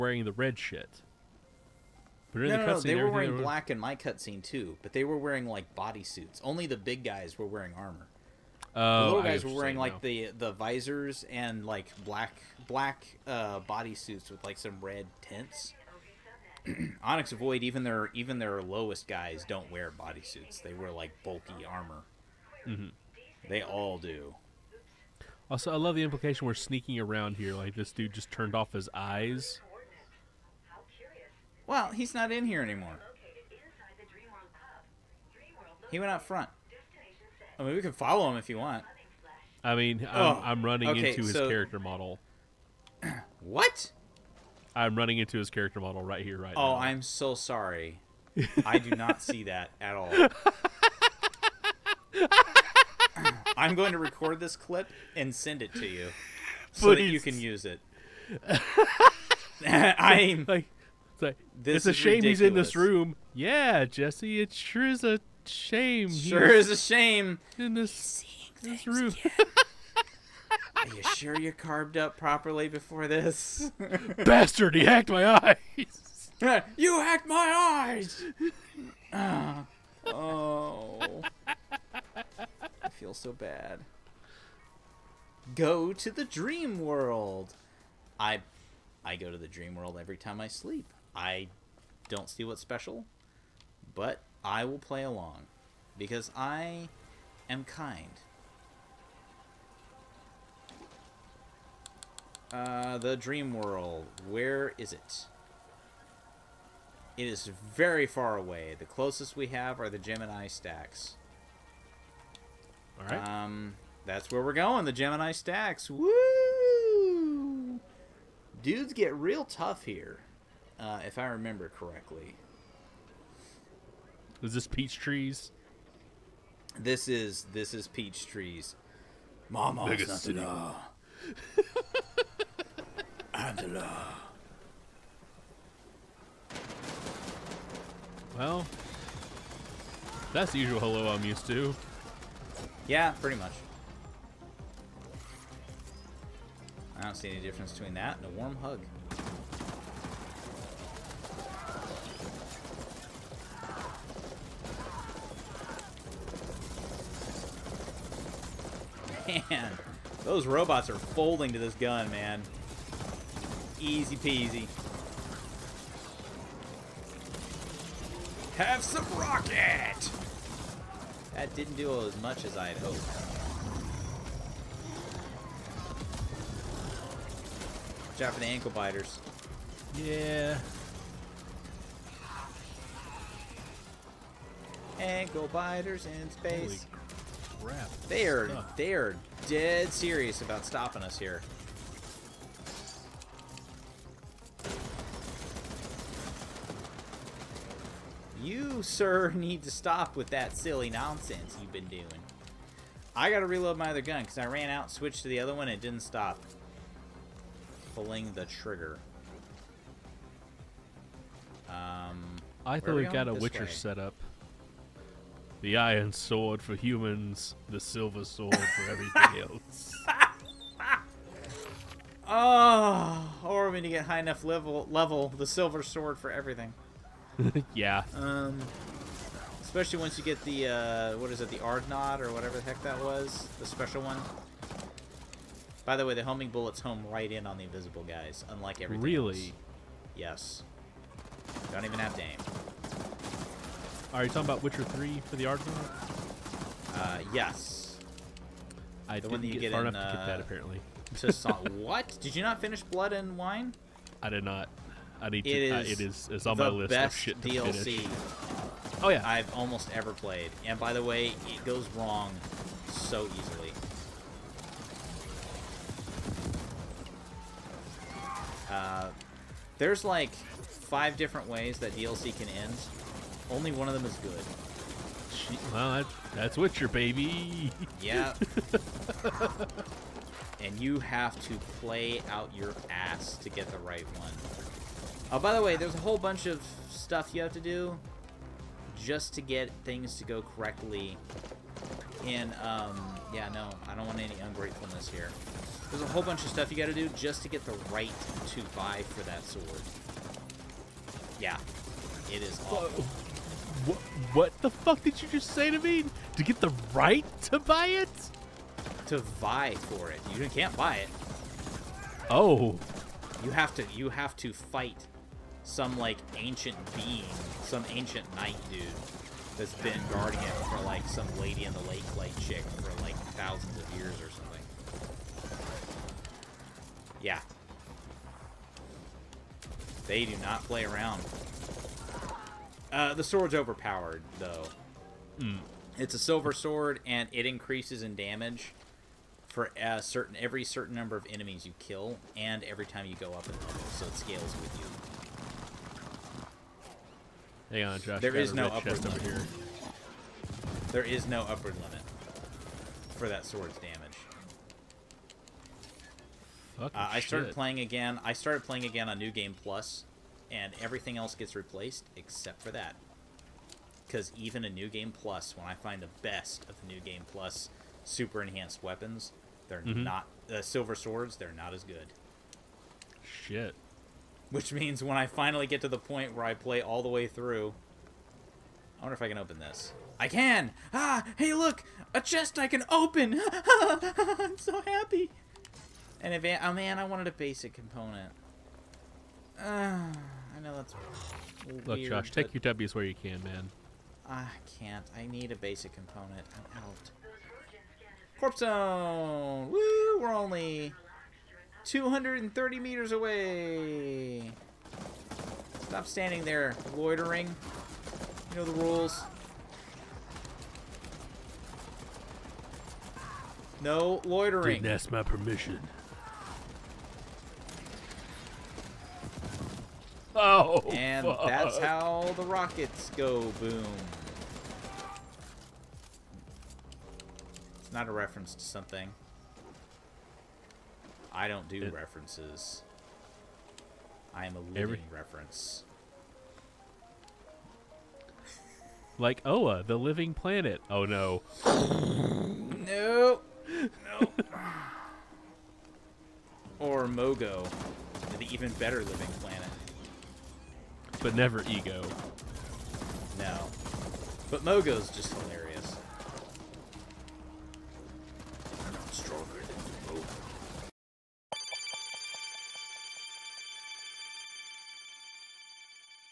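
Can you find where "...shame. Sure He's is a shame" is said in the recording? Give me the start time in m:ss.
1:05.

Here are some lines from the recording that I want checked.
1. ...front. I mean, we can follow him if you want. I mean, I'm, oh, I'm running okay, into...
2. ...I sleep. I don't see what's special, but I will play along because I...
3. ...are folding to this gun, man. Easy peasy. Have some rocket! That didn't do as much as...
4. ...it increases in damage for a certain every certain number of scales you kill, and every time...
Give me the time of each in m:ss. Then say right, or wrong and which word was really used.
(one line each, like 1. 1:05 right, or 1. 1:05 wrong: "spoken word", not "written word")
1. 0:36 right
2. 1:30 right
3. 2:40 right
4. 5:37 wrong: "enemies", not "scales".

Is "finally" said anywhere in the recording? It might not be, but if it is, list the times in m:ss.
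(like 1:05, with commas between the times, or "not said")
6:15.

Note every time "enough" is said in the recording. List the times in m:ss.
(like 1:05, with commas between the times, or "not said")
3:44, 4:09.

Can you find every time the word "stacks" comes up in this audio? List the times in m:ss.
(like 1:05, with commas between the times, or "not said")
1:50, 1:55.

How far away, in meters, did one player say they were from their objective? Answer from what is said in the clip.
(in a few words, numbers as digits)
230.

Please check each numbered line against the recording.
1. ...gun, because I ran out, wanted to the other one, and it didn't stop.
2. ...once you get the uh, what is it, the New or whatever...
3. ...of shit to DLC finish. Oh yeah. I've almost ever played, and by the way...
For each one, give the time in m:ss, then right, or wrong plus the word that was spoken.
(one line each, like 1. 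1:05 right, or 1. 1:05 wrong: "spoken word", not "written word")
1. 3:24 wrong: "switched", not "wanted"
2. 3:49 wrong: "Ardnod", not "New"
3. 4:16 right.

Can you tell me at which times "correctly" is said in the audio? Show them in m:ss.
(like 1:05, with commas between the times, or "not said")
2:01, 4:50.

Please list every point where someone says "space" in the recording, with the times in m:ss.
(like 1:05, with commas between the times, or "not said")
3:06.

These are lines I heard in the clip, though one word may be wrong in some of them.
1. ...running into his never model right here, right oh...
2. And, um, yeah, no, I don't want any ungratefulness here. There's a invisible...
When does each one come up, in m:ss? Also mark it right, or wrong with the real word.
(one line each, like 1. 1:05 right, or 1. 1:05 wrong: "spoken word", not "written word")
1. 0:44 wrong: "character", not "never"
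2. 4:52 wrong: "whole", not "invisible".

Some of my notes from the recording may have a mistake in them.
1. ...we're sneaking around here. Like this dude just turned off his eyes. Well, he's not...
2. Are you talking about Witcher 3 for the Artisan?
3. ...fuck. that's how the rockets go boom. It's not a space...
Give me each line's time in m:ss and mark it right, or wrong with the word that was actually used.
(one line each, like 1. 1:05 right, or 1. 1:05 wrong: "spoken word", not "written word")
1. 0:26 right
2. 4:04 right
3. 7:01 wrong: "reference", not "space".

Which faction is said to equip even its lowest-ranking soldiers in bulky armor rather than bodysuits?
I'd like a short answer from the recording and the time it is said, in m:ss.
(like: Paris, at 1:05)
Onyx Void, at 0:17.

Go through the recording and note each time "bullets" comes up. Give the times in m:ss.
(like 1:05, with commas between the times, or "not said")
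3:56.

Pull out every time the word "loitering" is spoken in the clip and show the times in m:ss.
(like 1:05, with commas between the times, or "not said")
6:46, 6:54.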